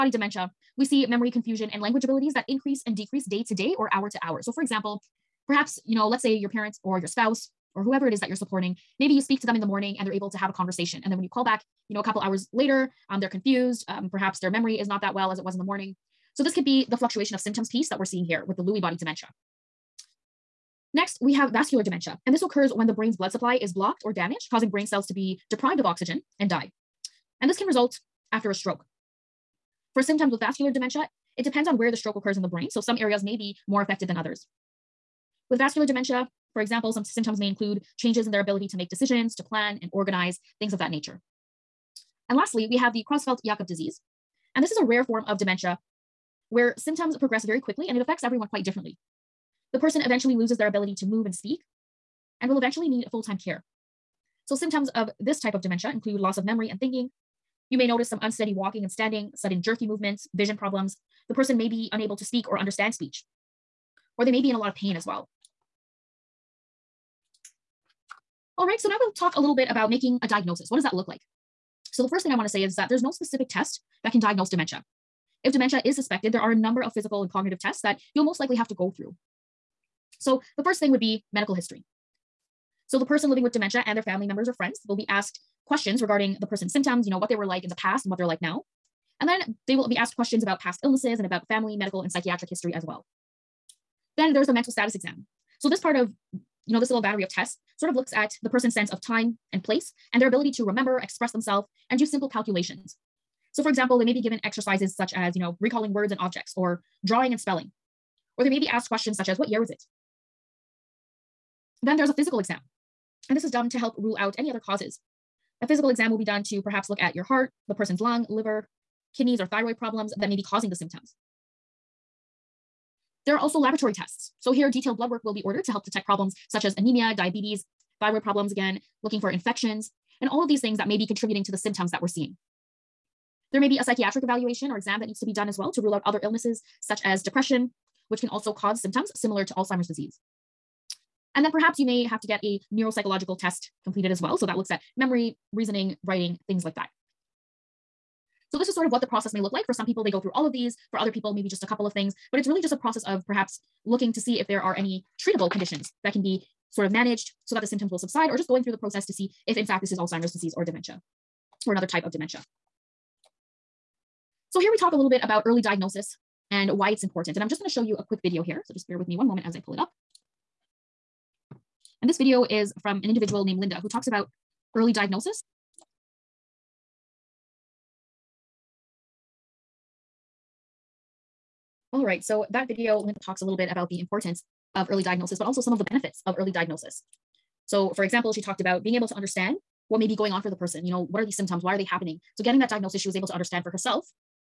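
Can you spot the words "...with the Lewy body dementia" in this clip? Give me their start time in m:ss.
0:18.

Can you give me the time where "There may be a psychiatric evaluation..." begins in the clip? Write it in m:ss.
2:13.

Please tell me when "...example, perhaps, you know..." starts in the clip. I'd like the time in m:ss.
0:04.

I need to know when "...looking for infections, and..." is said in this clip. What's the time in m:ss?
2:09.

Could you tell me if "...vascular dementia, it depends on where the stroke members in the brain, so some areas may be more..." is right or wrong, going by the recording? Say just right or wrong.
wrong.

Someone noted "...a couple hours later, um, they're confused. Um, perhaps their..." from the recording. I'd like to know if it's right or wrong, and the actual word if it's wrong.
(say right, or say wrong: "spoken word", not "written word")
right.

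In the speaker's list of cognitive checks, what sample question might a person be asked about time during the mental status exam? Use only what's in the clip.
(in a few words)
What year was it?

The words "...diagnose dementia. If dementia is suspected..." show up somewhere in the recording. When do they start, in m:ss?
1:14.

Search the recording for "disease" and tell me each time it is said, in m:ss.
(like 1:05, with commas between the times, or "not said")
0:43, 2:19, 2:40.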